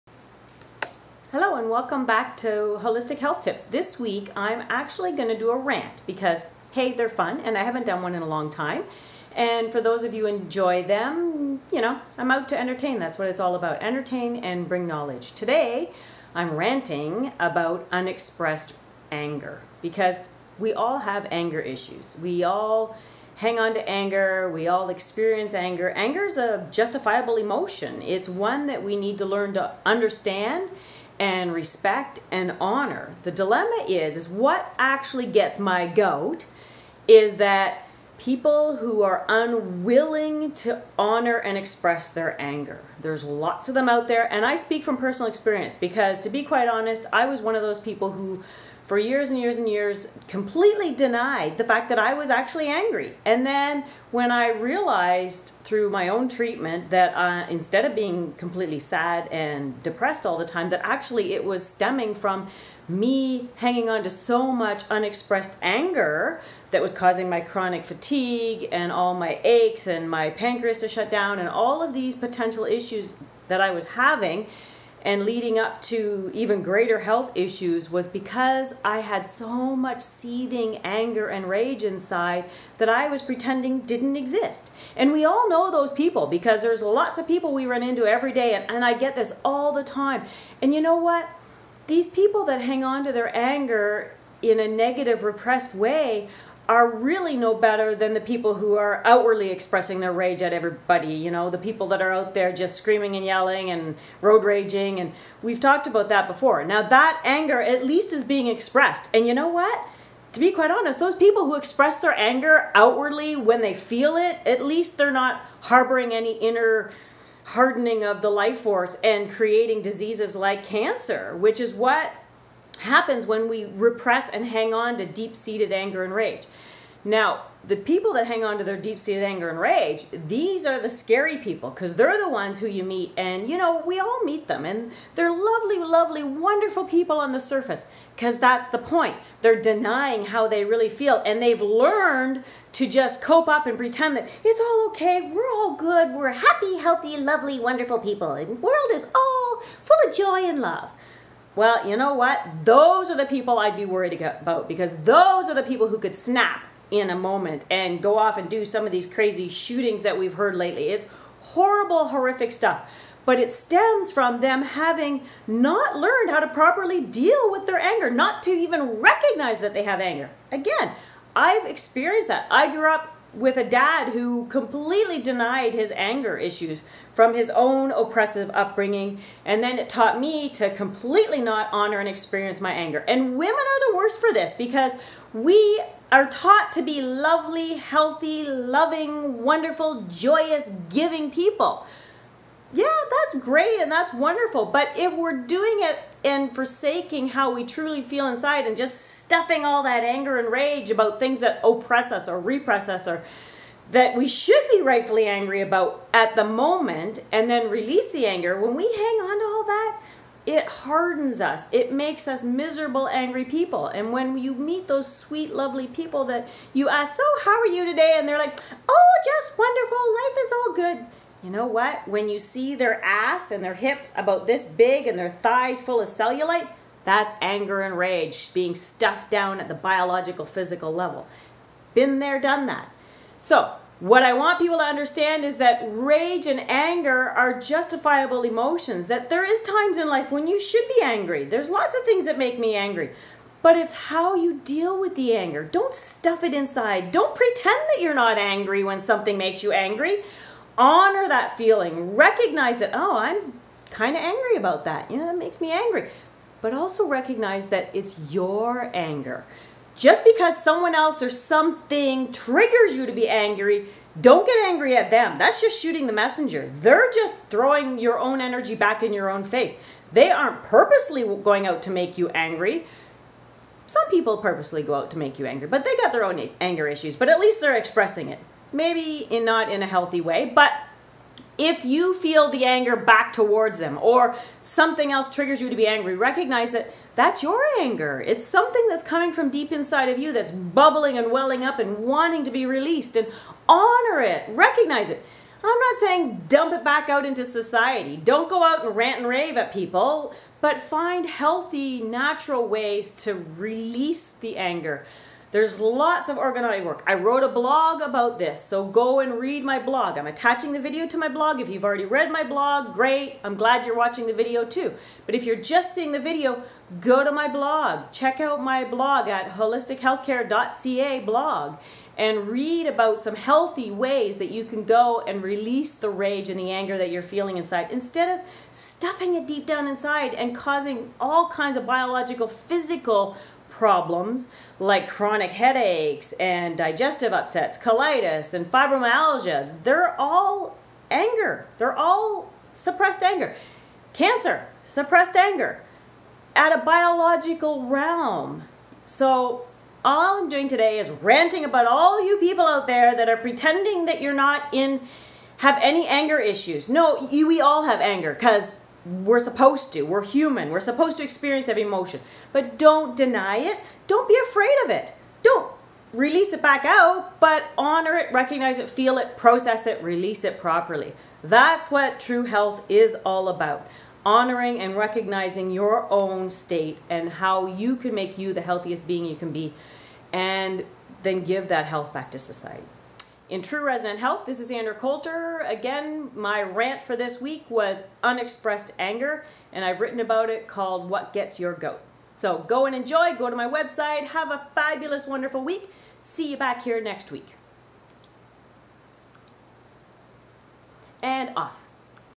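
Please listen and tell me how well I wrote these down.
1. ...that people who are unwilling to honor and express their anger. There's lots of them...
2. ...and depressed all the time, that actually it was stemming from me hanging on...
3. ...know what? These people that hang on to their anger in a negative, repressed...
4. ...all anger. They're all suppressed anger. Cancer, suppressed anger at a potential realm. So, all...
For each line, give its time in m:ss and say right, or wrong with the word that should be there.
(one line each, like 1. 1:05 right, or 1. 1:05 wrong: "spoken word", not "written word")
1. 0:37 right
2. 0:59 right
3. 1:30 right
4. 5:40 wrong: "biological", not "potential".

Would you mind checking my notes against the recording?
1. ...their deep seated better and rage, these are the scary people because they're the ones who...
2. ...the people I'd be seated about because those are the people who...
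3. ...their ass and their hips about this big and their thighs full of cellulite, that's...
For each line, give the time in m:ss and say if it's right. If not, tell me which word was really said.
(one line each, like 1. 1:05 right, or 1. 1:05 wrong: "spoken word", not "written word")
1. 2:08 wrong: "anger", not "better"
2. 2:33 wrong: "worried", not "seated"
3. 3:42 right.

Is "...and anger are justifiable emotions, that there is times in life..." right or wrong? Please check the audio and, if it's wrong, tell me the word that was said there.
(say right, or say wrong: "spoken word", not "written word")
right.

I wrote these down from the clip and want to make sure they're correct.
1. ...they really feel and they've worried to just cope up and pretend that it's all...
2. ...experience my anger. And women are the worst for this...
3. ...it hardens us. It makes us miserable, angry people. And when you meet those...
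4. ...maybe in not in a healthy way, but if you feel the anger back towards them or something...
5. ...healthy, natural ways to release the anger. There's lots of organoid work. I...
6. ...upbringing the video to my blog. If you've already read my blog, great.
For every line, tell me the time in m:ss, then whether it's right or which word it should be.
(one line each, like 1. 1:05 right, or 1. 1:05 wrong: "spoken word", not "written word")
1. 2:20 wrong: "learned", not "worried"
2. 3:02 right
3. 3:30 right
4. 4:38 right
5. 5:01 right
6. 5:10 wrong: "attaching", not "upbringing".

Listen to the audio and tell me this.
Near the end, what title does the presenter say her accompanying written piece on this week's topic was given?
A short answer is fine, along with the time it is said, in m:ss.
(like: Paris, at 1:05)
What Gets Your Goat, at 6:31.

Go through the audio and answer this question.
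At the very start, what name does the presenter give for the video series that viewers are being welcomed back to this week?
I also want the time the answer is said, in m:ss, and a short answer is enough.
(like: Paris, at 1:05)
Wholistic Health Tips, at 0:02.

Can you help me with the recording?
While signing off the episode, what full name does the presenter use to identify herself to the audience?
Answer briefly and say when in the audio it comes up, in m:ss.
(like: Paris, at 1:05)
Andrea Coulter, at 6:24.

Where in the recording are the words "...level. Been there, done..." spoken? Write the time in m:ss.
3:50.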